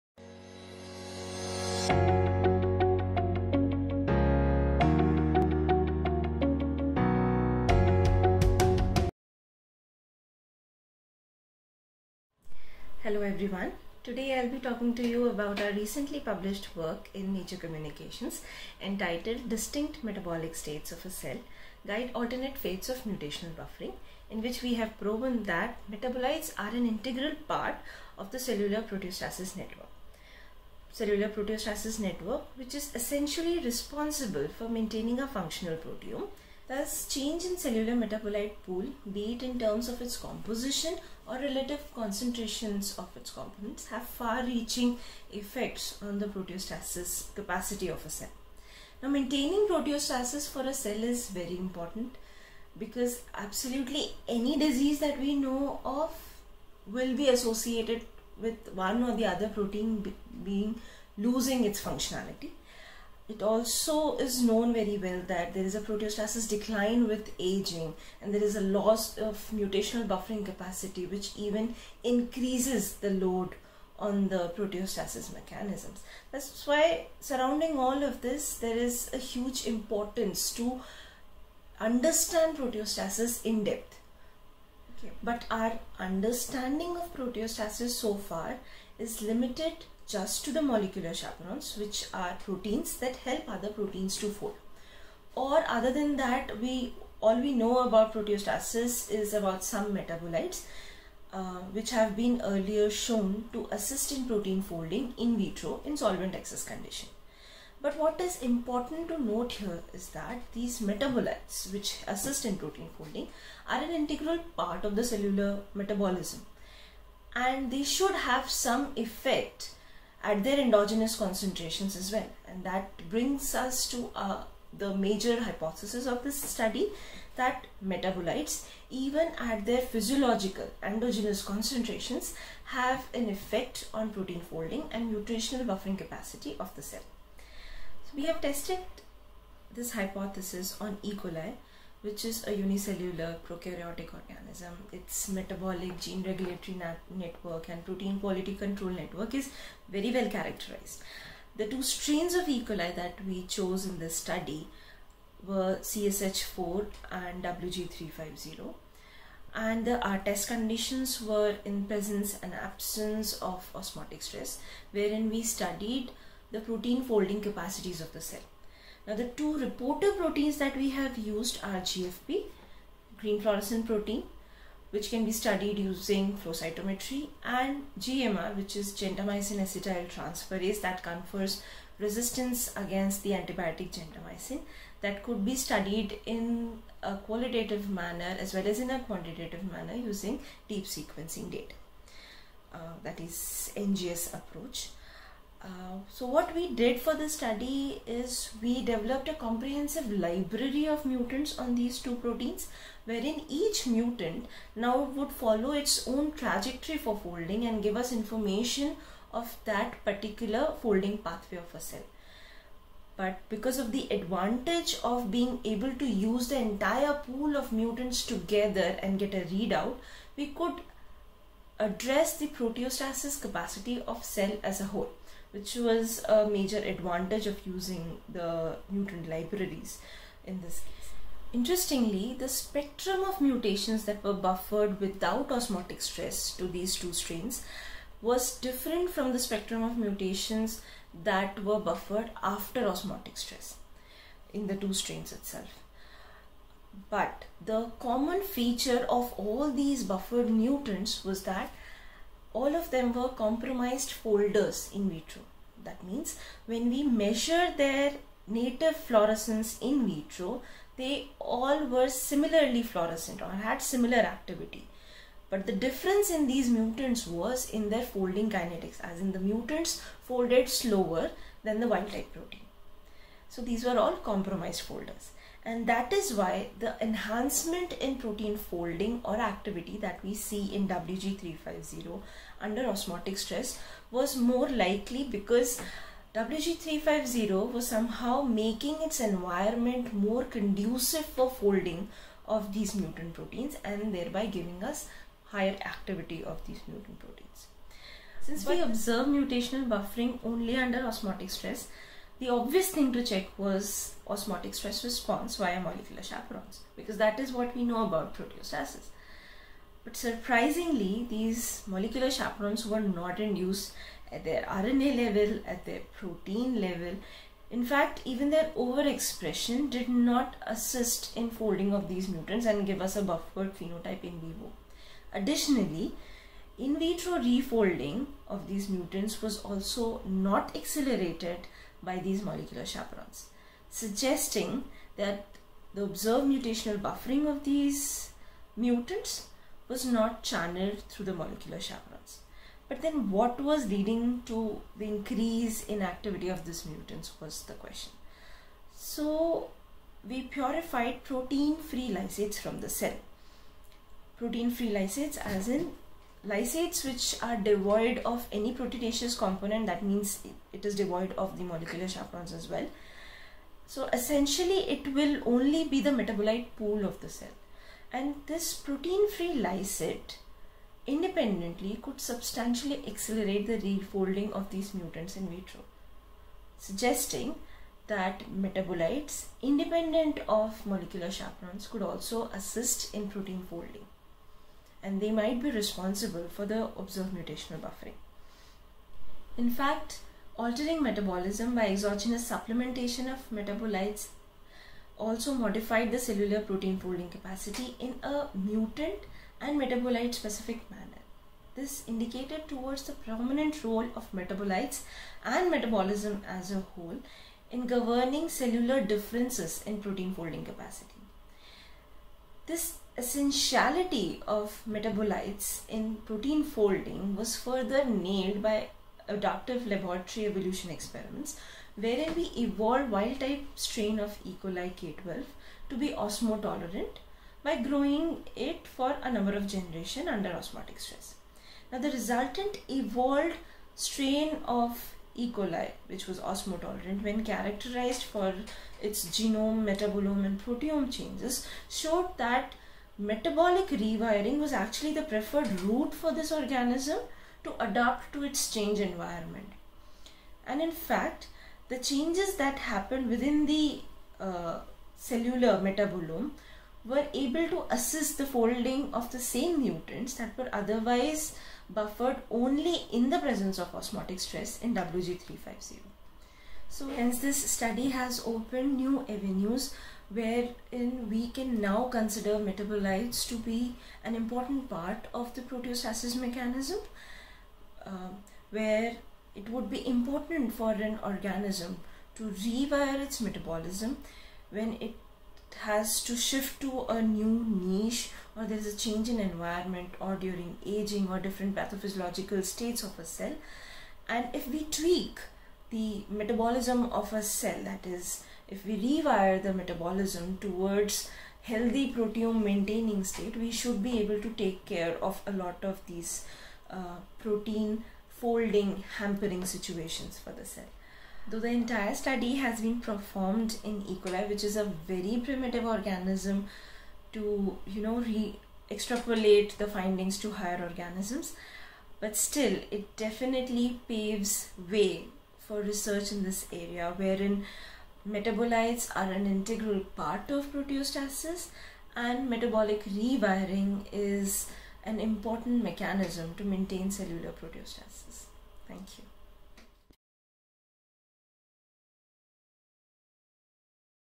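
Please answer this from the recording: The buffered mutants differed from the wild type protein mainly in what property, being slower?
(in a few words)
folding kinetics.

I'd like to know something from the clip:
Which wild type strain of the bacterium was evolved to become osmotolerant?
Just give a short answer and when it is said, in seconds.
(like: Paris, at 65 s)
E. coli K12, at 424 s.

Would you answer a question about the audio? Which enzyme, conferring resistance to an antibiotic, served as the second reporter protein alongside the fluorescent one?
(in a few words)
gentamicin acetyltransferase.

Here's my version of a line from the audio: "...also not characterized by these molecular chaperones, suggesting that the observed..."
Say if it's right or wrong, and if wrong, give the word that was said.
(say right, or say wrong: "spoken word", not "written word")
wrong: "accelerated", not "characterized".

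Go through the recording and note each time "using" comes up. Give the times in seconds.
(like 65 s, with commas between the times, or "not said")
175 s, 189 s, 227 s.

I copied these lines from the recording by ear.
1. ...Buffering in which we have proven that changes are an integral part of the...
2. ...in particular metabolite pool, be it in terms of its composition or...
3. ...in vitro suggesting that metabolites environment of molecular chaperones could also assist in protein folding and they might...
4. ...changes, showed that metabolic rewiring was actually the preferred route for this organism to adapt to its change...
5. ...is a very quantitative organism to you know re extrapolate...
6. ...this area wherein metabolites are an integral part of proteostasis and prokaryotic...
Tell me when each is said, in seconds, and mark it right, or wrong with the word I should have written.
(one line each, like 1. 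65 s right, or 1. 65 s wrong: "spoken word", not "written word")
1. 23 s wrong: "metabolites", not "changes"
2. 37 s wrong: "cellular", not "particular"
3. 375 s wrong: "independent", not "environment"
4. 441 s right
5. 514 s wrong: "primitive", not "quantitative"
6. 526 s wrong: "metabolic", not "prokaryotic".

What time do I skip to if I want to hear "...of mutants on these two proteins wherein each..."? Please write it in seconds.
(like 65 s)
200 s.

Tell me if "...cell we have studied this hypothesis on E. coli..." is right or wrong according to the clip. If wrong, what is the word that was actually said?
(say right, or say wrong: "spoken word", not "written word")
wrong: "tested", not "studied".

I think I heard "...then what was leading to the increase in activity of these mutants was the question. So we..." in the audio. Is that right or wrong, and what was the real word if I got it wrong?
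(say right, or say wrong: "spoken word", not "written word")
right.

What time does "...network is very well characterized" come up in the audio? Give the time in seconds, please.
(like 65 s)
148 s.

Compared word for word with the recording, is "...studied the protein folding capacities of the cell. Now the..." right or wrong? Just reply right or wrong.
right.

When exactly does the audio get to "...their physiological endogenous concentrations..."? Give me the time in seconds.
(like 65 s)
129 s.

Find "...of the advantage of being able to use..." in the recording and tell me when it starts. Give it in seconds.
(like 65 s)
213 s.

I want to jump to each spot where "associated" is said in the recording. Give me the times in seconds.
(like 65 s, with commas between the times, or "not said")
57 s.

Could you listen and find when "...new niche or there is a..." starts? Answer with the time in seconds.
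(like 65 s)
487 s.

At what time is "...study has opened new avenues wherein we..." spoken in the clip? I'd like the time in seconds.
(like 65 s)
467 s.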